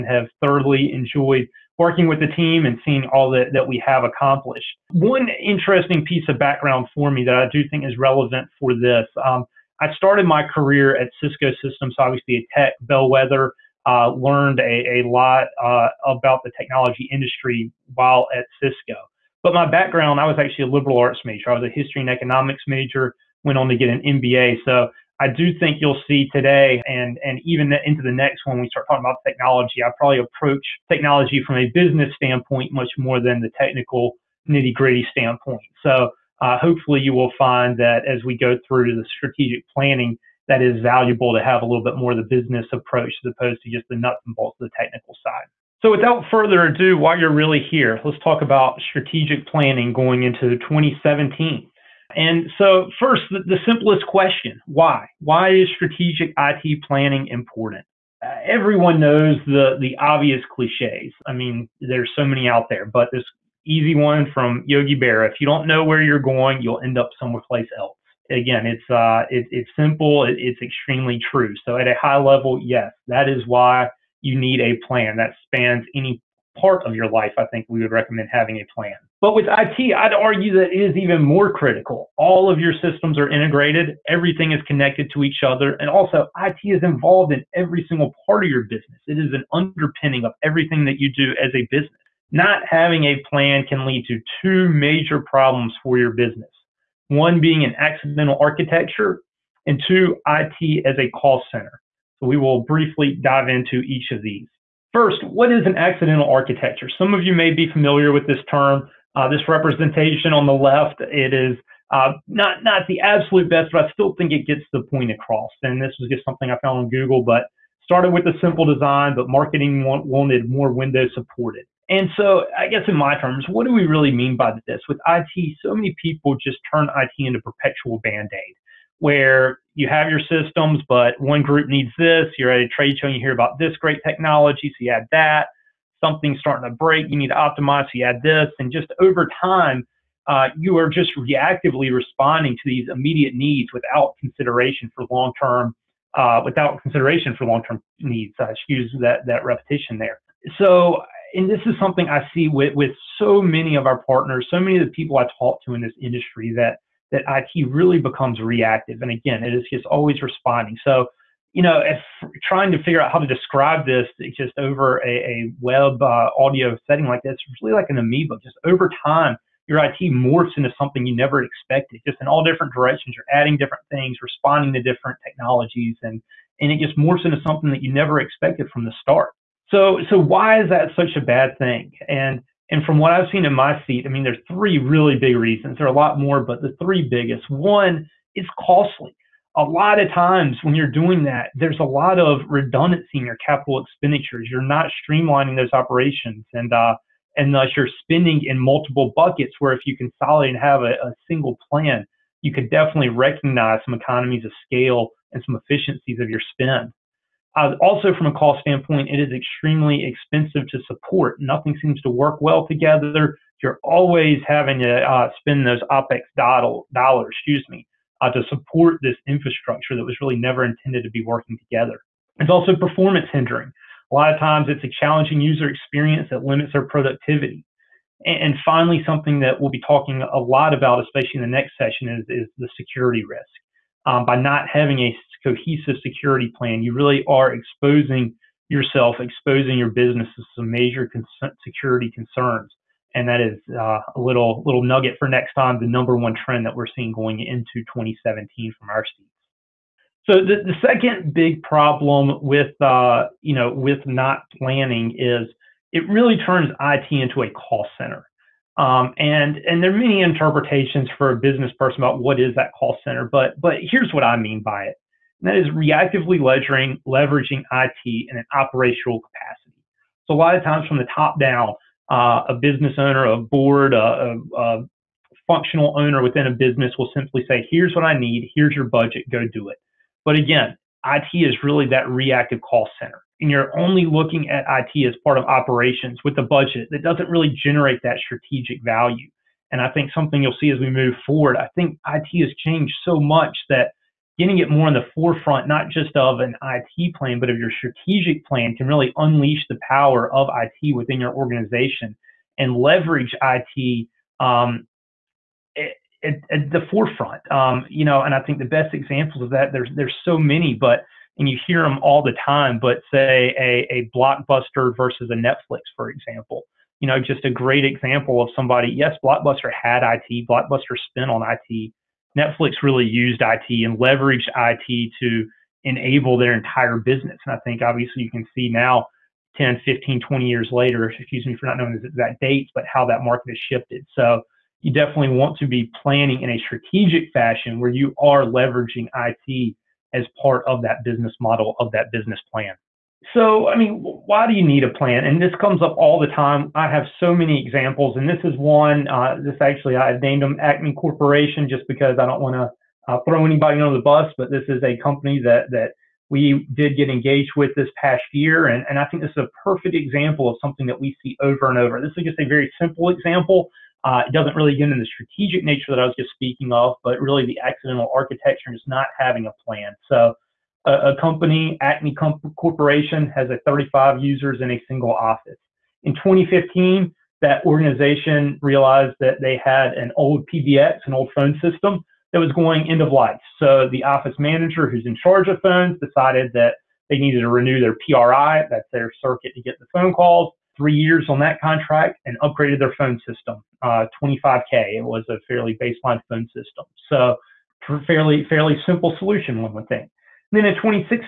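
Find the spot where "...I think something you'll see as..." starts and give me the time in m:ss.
4:49.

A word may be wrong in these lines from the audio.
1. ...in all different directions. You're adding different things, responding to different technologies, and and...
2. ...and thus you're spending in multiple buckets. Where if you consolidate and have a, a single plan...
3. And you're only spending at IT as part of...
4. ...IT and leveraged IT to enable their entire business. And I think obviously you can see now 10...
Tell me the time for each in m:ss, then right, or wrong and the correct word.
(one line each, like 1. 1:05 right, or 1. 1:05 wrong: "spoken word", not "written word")
1. 2:52 right
2. 3:17 right
3. 4:43 wrong: "looking", not "spending"
4. 5:23 right.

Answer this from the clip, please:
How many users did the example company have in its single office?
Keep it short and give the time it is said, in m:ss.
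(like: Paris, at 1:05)
35, at 6:13.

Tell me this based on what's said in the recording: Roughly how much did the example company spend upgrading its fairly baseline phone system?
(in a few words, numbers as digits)
25K.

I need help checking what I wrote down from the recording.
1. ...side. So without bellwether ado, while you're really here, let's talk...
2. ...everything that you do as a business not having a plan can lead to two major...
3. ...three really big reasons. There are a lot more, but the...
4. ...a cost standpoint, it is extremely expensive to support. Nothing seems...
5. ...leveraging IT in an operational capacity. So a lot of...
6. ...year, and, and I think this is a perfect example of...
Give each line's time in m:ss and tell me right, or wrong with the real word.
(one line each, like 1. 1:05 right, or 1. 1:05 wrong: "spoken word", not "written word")
1. 0:45 wrong: "further", not "bellwether"
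2. 1:30 right
3. 3:04 right
4. 3:28 right
5. 4:27 right
6. 5:58 right.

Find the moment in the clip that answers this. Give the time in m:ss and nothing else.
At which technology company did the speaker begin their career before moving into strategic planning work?
0:11.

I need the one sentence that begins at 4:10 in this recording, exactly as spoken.
So the, the second big problem with uh, you know with not planning is it really turns IT into a call center.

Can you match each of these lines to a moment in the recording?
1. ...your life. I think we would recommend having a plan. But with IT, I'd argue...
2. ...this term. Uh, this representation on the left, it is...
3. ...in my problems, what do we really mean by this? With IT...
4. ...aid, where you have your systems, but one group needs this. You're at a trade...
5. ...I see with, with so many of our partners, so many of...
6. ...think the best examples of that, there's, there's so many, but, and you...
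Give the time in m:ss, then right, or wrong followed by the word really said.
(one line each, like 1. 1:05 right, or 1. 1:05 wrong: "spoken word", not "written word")
1. 1:16 right
2. 1:48 right
3. 2:02 wrong: "terms", not "problems"
4. 2:08 right
5. 2:32 right
6. 5:08 right.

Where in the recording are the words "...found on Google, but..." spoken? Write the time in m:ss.
1:56.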